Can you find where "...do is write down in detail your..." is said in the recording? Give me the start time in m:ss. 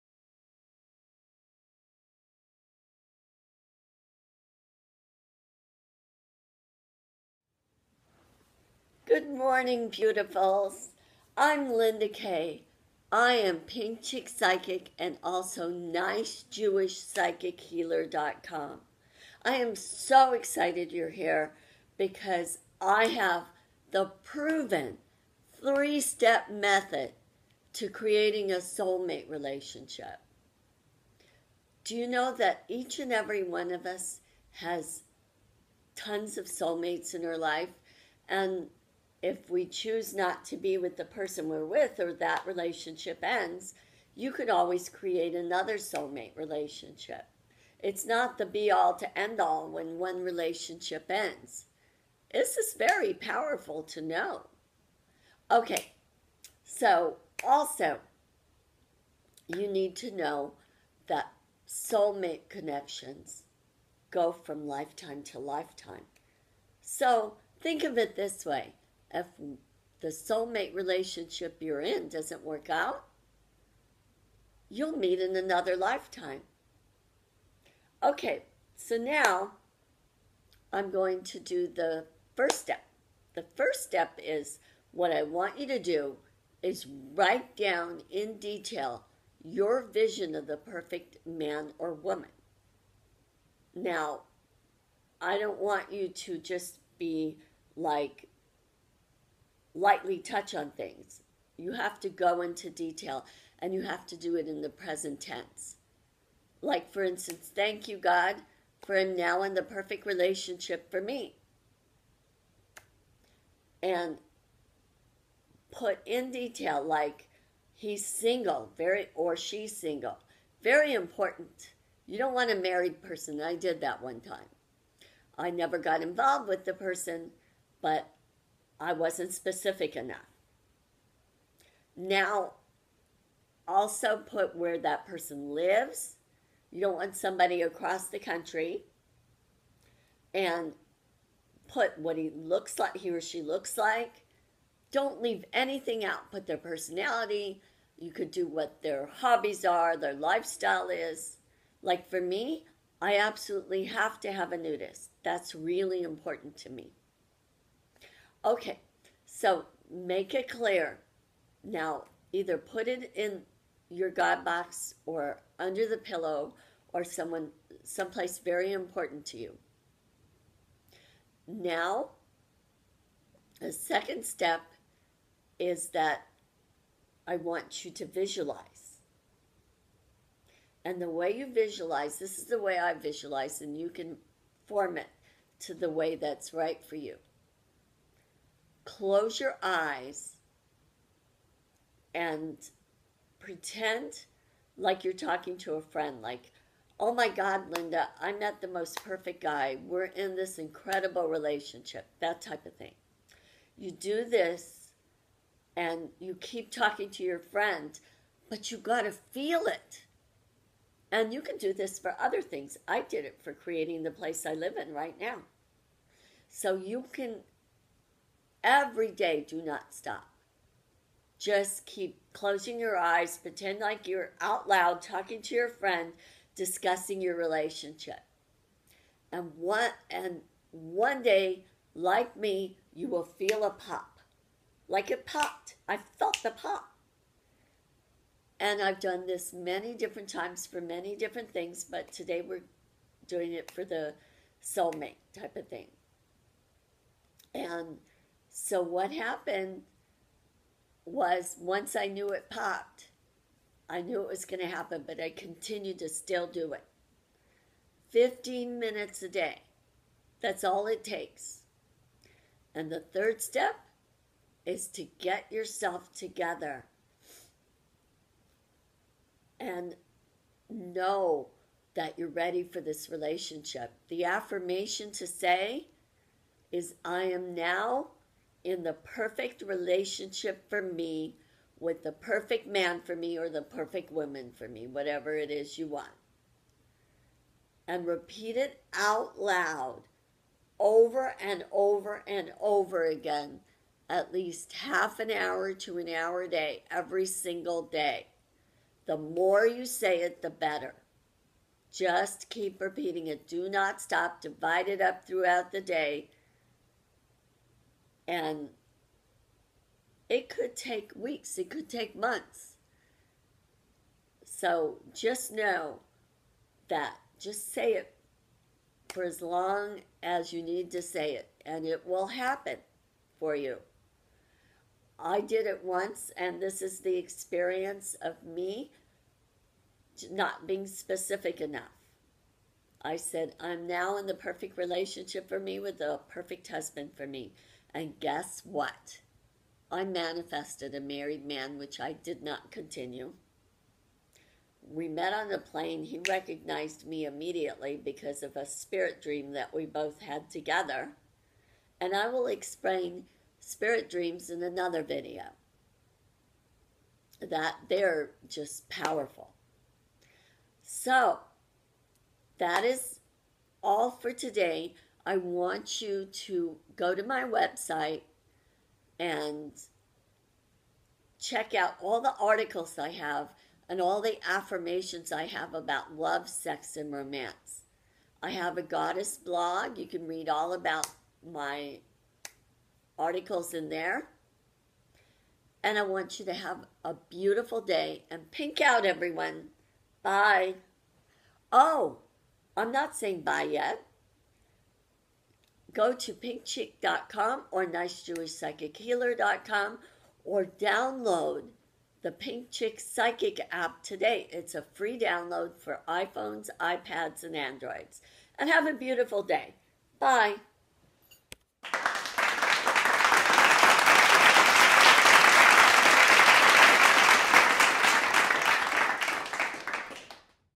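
1:25.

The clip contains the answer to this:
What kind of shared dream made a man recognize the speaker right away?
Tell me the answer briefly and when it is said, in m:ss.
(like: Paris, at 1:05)
spirit dream, at 5:48.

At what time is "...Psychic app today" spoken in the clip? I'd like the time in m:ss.
6:42.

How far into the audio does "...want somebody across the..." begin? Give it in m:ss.
2:16.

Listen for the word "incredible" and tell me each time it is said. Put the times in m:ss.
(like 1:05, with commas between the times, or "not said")
3:20.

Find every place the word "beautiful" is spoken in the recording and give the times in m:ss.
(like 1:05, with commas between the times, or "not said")
0:09, 6:27, 6:48.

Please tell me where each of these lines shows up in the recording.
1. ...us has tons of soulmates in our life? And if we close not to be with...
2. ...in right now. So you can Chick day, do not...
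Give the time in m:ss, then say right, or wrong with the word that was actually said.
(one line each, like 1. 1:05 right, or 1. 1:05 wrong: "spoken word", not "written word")
1. 0:33 wrong: "choose", not "close"
2. 3:34 wrong: "Every", not "Chick".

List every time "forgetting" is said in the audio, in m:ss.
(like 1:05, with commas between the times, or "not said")
not said.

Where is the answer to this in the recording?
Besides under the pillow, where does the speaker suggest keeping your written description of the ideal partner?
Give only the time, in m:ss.
2:44.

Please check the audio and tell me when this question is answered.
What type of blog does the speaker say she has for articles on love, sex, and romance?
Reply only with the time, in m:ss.
6:18.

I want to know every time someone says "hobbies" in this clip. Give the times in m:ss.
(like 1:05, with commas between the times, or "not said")
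2:29.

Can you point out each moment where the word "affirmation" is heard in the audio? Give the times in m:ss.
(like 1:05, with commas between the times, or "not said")
4:34, 6:14.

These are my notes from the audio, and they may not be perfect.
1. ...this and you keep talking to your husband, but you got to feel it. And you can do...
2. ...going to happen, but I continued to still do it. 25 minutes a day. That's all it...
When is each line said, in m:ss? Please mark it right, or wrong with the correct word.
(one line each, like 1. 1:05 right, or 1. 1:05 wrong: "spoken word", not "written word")
1. 3:24 wrong: "friend", not "husband"
2. 4:14 wrong: "15", not "25".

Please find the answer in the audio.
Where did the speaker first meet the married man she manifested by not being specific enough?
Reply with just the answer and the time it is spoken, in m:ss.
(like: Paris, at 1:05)
on the plane, at 5:45.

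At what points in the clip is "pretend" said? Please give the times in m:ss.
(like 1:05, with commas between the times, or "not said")
3:13, 3:43.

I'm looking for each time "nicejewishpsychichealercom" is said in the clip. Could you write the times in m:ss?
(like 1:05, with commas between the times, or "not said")
0:15, 6:37.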